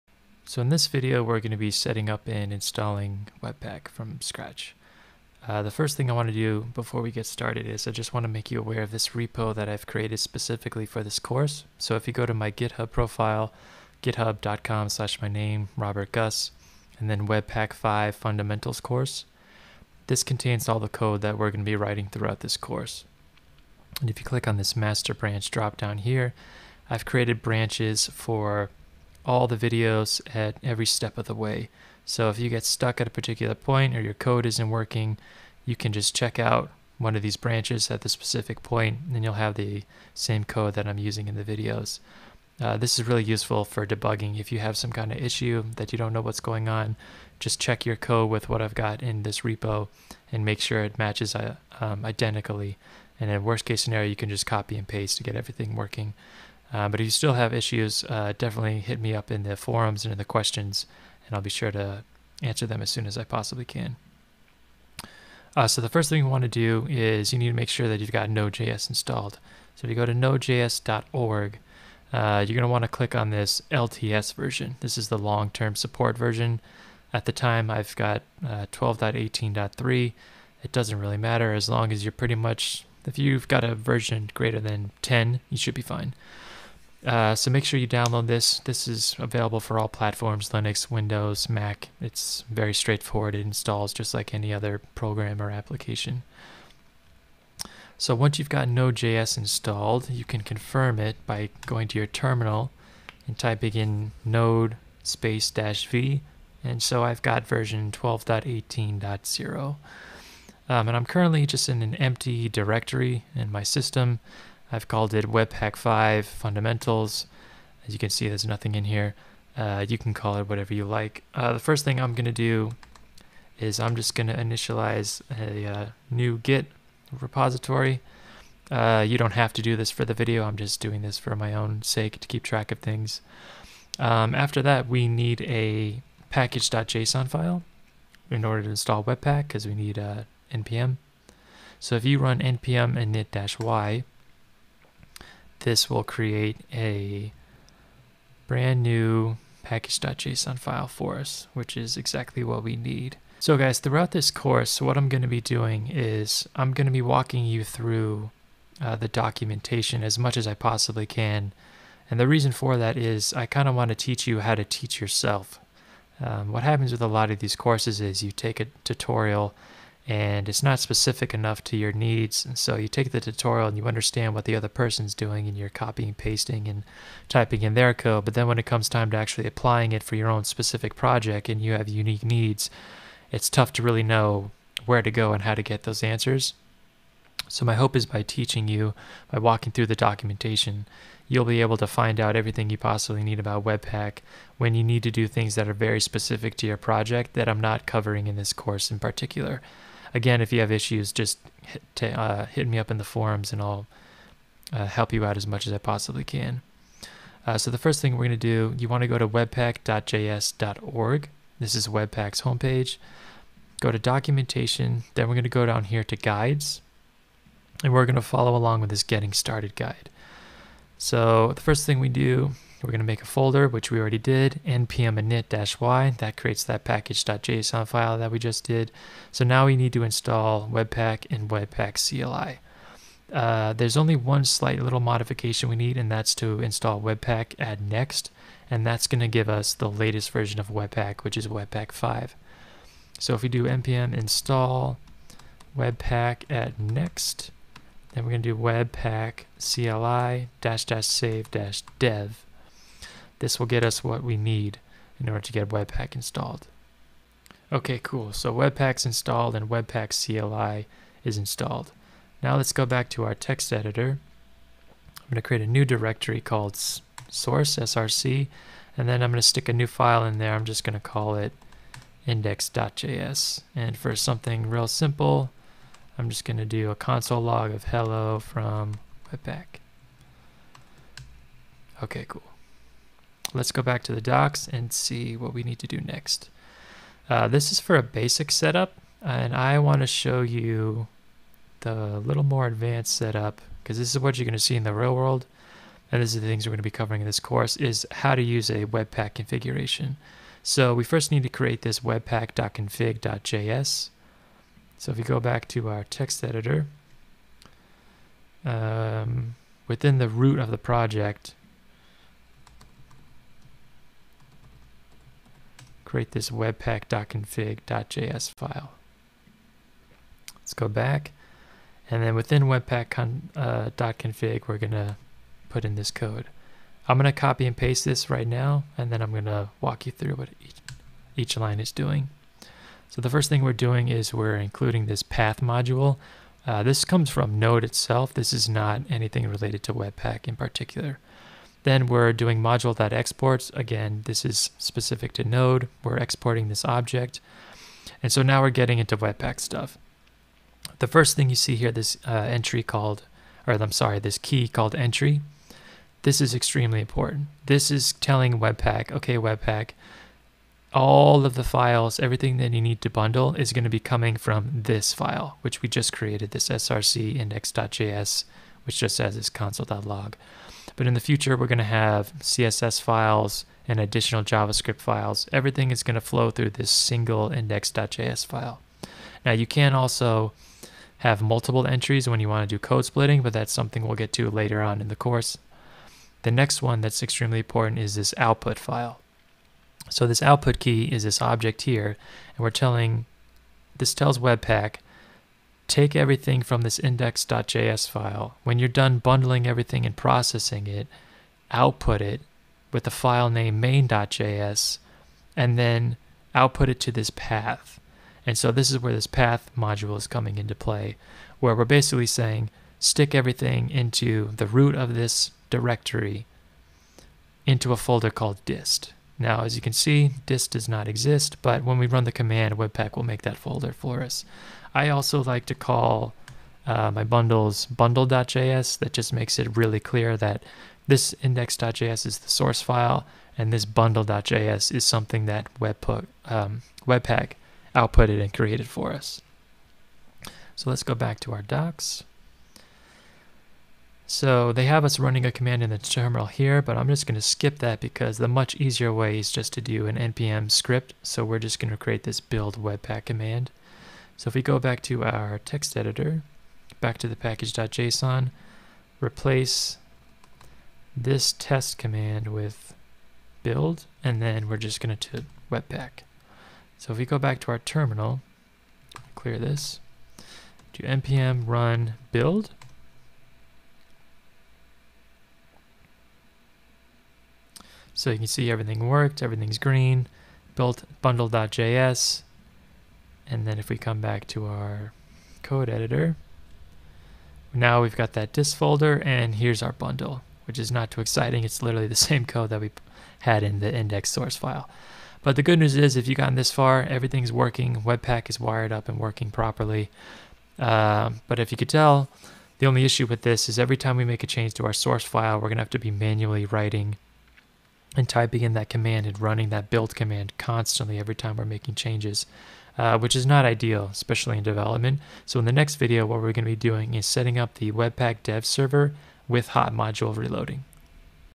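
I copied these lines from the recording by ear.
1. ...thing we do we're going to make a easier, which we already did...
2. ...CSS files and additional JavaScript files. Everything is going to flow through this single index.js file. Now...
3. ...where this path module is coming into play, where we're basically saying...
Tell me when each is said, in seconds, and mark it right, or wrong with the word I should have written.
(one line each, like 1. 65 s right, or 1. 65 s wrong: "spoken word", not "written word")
1. 221 s wrong: "folder", not "easier"
2. 372 s right
3. 408 s right.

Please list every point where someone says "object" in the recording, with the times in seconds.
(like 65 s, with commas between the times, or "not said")
346 s, 391 s.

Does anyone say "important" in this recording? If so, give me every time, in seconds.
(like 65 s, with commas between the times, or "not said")
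357 s, 387 s.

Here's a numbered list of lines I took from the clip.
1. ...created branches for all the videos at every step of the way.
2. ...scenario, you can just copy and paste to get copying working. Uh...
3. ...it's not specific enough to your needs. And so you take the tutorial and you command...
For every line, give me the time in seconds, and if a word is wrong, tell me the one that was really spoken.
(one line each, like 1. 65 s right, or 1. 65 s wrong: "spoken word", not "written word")
1. 27 s right
2. 53 s wrong: "everything", not "copying"
3. 170 s wrong: "understand", not "command".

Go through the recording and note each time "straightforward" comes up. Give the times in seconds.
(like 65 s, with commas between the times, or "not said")
92 s.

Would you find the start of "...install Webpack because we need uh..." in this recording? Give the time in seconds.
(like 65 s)
138 s.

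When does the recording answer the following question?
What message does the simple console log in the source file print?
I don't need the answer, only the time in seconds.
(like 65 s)
277 s.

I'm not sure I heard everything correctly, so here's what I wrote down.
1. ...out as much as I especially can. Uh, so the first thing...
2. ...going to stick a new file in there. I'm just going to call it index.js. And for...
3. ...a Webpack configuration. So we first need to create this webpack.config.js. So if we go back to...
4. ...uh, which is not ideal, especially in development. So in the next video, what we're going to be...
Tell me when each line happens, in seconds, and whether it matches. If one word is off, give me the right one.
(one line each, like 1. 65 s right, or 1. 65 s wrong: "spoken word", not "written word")
1. 205 s wrong: "possibly", not "especially"
2. 269 s right
3. 298 s right
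4. 512 s right.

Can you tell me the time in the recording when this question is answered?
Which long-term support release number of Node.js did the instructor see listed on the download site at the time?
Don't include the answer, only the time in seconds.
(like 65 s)
78 s.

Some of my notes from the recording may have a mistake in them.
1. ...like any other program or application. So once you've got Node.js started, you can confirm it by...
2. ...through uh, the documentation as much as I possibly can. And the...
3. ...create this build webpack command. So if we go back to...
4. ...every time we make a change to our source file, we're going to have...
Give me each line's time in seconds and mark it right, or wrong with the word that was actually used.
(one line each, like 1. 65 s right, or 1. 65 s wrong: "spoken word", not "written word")
1. 94 s wrong: "installed", not "started"
2. 157 s right
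3. 451 s right
4. 503 s right.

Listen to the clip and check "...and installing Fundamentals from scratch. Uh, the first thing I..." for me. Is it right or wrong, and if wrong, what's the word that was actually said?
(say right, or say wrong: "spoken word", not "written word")
wrong: "Webpack", not "Fundamentals".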